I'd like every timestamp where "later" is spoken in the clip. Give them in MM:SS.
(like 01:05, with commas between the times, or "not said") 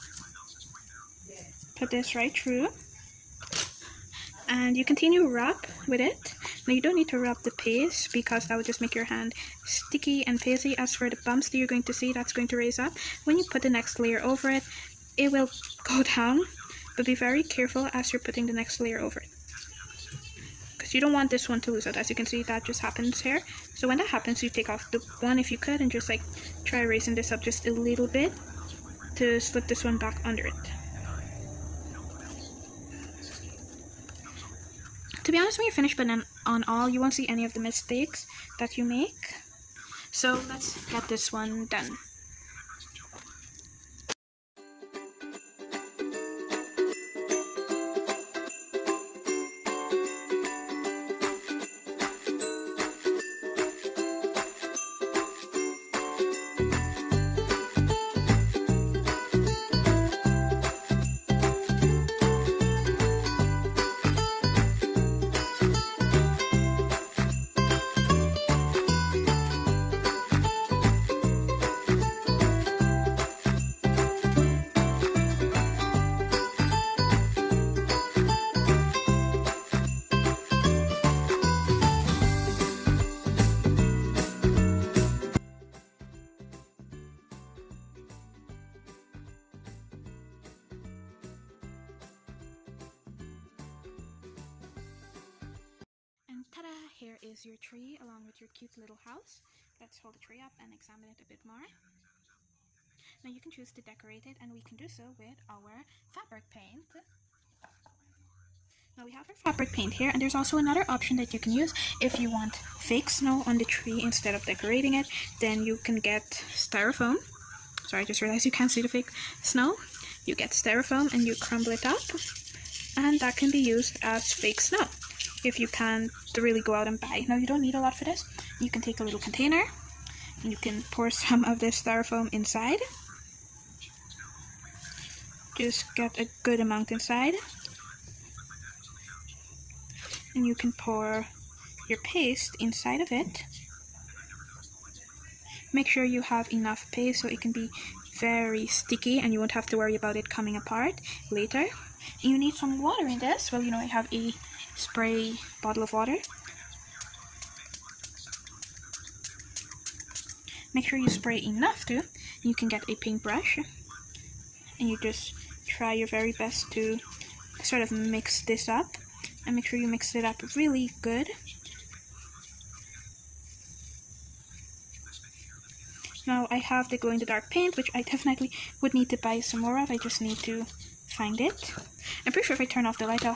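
02:31.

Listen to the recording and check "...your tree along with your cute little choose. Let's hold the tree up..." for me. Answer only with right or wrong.
wrong.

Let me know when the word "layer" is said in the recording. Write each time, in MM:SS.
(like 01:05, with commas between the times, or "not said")
00:13, 00:18.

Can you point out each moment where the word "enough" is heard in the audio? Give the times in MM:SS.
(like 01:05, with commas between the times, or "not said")
02:26, 02:41.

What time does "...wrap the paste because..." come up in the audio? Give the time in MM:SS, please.
00:07.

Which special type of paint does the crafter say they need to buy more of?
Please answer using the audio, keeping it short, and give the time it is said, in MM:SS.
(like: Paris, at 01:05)
glow-in-the-dark paint, at 02:56.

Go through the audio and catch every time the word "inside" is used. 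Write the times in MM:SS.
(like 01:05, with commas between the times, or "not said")
02:12, 02:16, 02:22.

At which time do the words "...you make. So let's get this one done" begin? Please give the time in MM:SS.
00:38.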